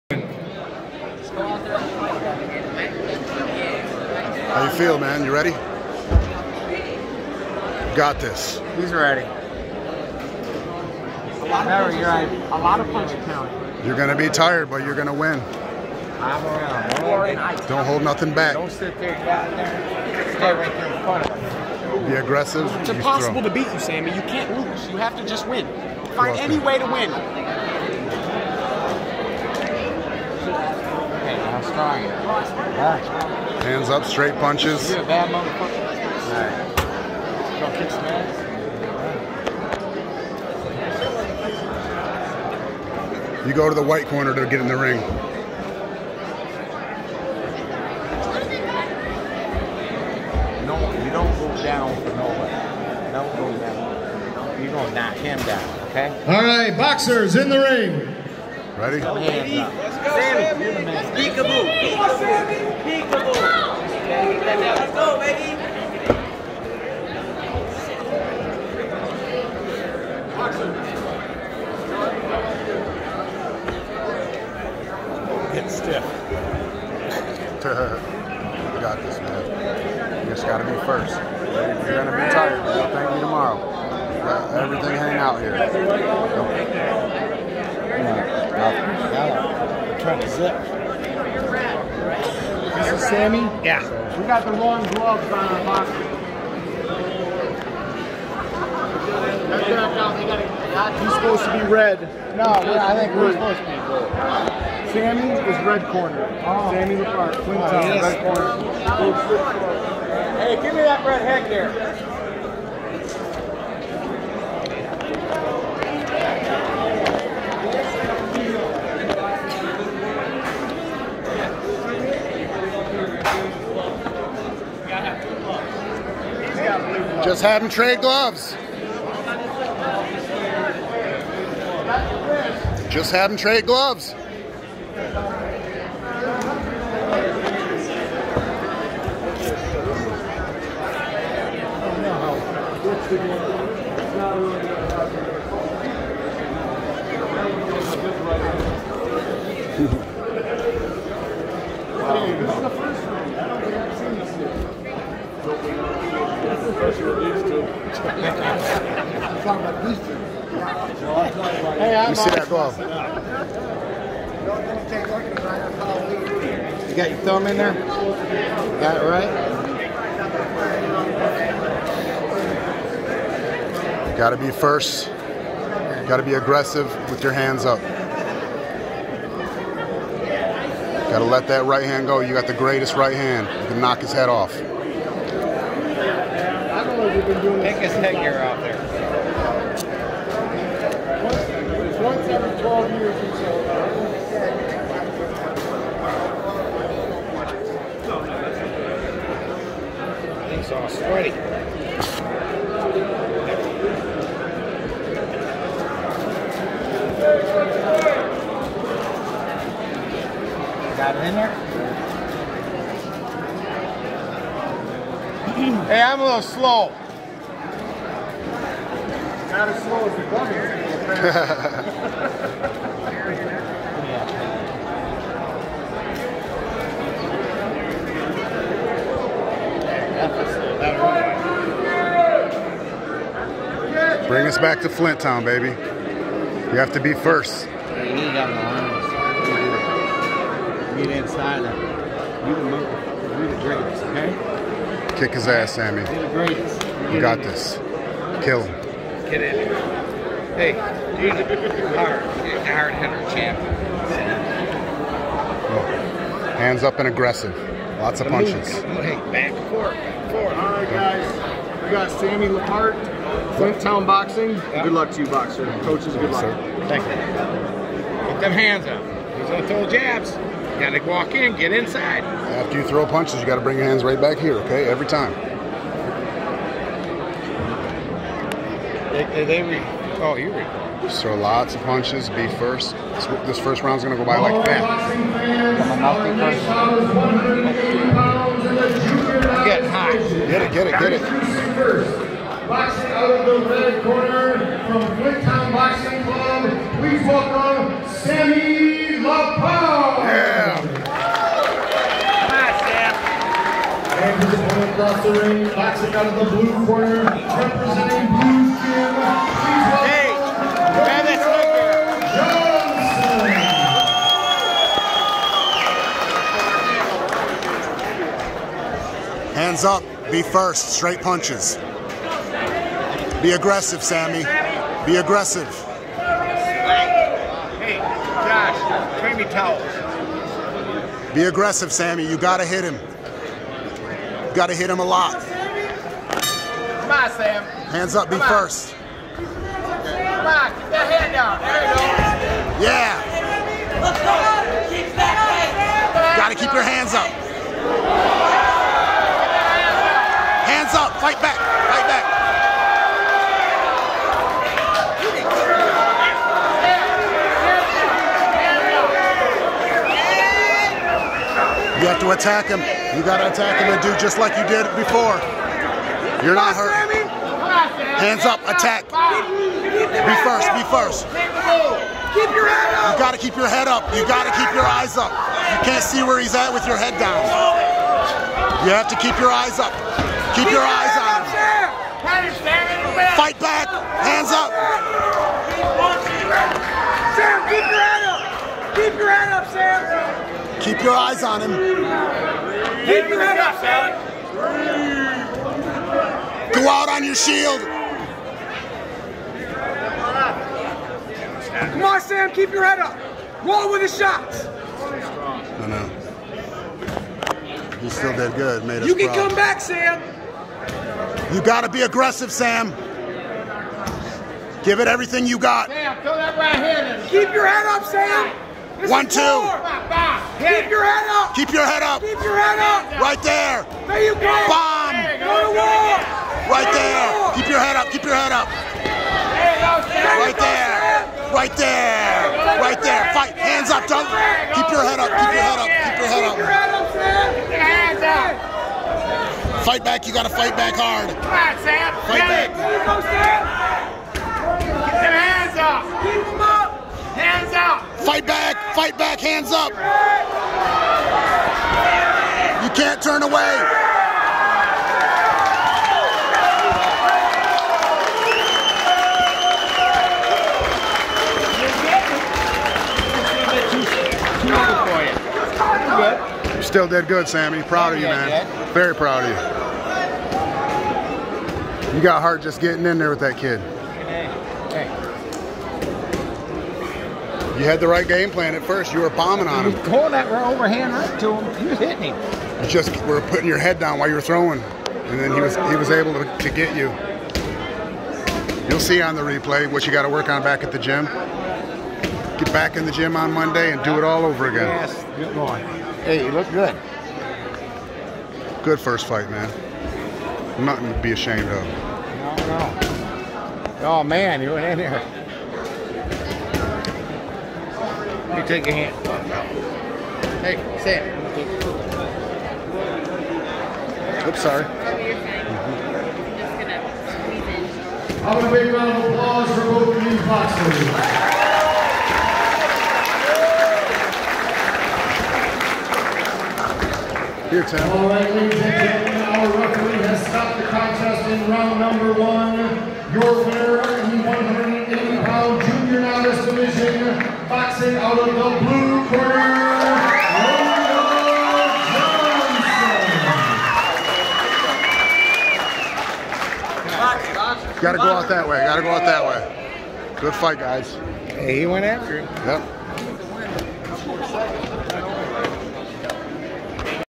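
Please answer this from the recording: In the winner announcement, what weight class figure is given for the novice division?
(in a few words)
180 pounds.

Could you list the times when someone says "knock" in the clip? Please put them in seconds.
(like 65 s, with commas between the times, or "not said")
54 s, 183 s.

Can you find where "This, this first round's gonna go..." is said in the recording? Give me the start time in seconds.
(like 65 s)
283 s.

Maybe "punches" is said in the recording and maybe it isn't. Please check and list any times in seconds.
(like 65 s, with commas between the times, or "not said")
12 s, 34 s, 258 s, 273 s, 281 s, 321 s.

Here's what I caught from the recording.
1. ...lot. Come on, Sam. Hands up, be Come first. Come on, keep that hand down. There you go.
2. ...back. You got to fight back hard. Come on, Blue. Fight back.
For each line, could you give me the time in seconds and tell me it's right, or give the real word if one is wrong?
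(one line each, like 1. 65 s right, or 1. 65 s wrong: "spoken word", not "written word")
1. 335 s right
2. 440 s wrong: "Sam", not "Blue".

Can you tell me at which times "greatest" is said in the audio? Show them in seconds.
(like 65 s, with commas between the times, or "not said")
182 s, 243 s.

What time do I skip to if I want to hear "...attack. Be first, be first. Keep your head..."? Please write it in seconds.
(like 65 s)
368 s.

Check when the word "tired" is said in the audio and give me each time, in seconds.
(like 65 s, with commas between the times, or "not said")
14 s, 82 s.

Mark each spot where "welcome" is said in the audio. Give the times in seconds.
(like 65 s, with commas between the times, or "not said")
297 s.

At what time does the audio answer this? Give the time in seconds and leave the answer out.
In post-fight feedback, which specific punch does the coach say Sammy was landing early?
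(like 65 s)
480 s.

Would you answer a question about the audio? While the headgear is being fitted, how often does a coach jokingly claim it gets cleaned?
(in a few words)
Once every 12 years.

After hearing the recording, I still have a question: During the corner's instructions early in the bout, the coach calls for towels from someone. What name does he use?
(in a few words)
Josh.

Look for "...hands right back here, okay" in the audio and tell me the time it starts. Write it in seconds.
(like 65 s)
273 s.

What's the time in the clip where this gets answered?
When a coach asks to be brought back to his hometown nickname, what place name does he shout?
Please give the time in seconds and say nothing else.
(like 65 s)
234 s.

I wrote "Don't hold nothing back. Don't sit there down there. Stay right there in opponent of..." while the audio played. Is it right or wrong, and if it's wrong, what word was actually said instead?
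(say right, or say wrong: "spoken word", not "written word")
wrong: "front", not "opponent".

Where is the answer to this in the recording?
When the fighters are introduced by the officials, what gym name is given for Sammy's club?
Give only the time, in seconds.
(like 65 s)
263 s.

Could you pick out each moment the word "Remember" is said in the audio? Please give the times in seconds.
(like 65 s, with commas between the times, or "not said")
11 s.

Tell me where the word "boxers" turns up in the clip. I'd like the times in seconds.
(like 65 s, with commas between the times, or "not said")
56 s, 265 s, 520 s.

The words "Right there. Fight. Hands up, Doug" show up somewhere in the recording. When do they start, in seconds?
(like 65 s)
432 s.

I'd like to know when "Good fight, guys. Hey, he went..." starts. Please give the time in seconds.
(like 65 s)
550 s.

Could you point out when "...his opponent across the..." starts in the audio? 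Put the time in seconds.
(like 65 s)
304 s.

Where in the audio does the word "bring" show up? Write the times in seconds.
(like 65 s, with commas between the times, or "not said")
234 s, 273 s, 329 s.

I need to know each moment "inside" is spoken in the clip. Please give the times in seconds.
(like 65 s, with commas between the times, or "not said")
241 s, 271 s.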